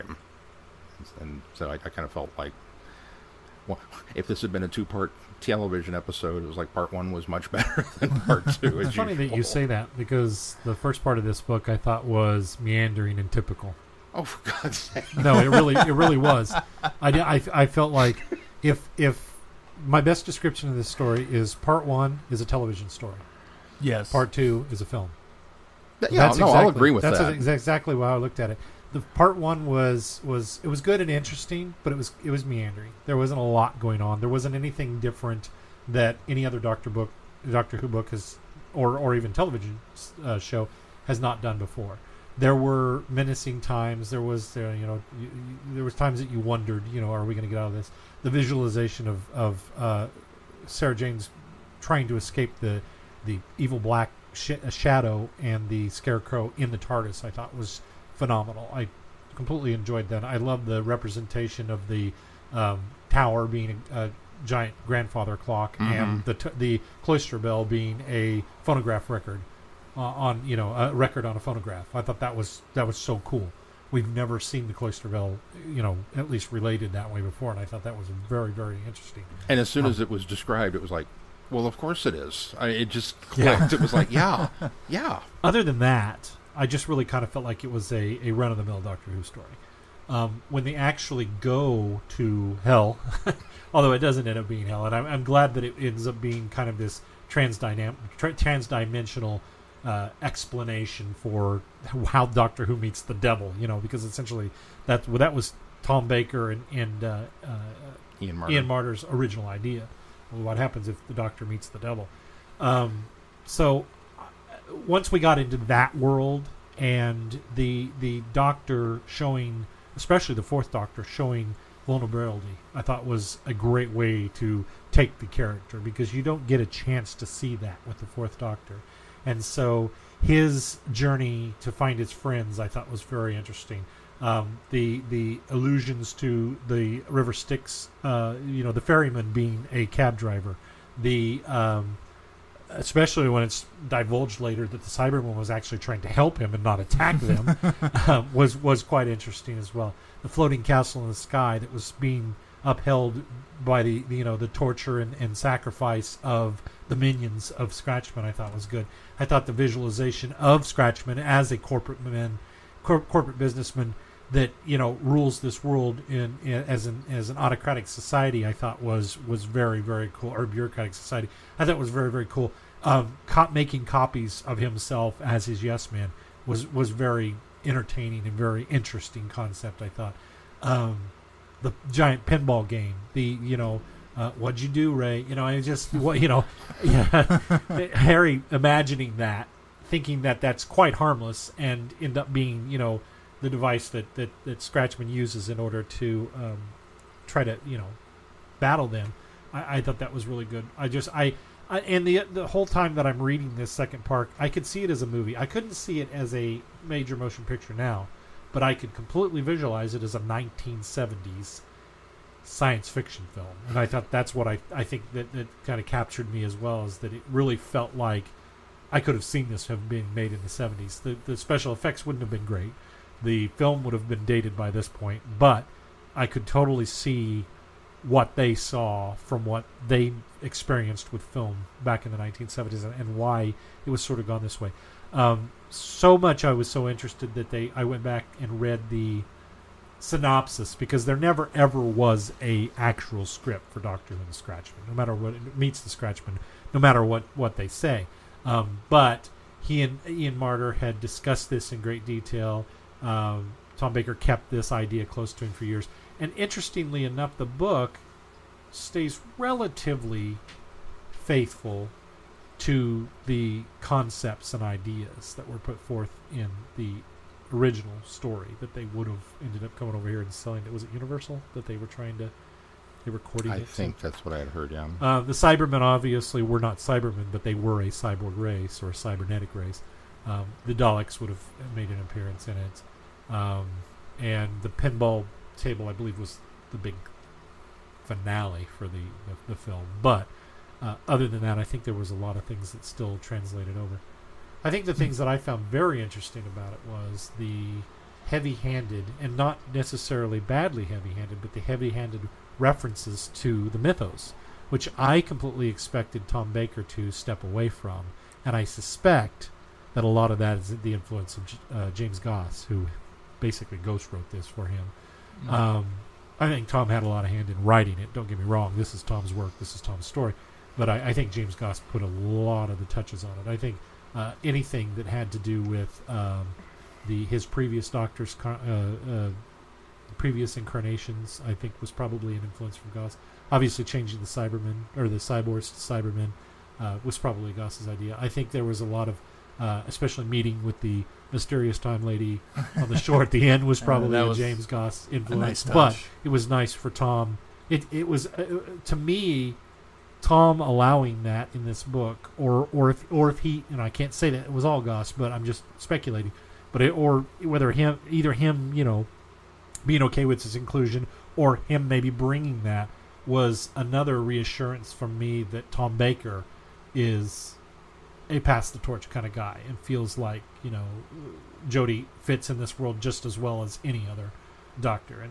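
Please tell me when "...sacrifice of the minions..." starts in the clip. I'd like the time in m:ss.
2:35.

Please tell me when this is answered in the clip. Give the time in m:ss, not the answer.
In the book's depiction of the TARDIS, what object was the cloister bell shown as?
1:08.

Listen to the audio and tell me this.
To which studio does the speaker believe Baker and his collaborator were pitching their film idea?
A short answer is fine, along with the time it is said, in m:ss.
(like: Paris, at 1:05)
Universal, at 4:30.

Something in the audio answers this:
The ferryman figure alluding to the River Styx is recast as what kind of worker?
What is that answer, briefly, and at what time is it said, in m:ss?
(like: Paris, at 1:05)
a cab driver, at 2:19.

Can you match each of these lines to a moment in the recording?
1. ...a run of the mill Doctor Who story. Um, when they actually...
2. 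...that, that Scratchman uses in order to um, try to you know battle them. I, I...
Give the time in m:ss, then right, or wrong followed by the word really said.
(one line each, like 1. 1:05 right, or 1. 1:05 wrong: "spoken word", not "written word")
1. 1:28 right
2. 3:14 right.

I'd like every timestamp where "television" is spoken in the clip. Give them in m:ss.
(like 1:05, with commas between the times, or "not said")
0:05, 0:22, 0:39.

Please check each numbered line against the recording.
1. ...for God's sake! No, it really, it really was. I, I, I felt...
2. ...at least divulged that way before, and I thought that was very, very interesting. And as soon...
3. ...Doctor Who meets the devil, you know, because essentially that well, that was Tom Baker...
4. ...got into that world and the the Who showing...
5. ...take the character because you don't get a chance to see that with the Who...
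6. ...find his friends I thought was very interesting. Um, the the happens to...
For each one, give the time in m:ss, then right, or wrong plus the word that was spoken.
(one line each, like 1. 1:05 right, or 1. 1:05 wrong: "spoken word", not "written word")
1. 0:14 right
2. 1:16 wrong: "related", not "divulged"
3. 1:42 right
4. 1:55 wrong: "Doctor", not "Who"
5. 2:04 wrong: "Fourth", not "Who"
6. 2:11 wrong: "allusions", not "happens".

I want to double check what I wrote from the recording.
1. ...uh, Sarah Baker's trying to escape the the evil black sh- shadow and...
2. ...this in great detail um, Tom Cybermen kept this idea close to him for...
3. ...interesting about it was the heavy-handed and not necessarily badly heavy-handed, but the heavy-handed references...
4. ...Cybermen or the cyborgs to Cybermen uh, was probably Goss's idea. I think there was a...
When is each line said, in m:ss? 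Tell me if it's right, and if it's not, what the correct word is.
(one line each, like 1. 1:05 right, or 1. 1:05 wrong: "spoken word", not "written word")
1. 0:49 wrong: "Jane", not "Baker"
2. 4:11 wrong: "Baker", not "Cybermen"
3. 4:56 right
4. 5:34 right.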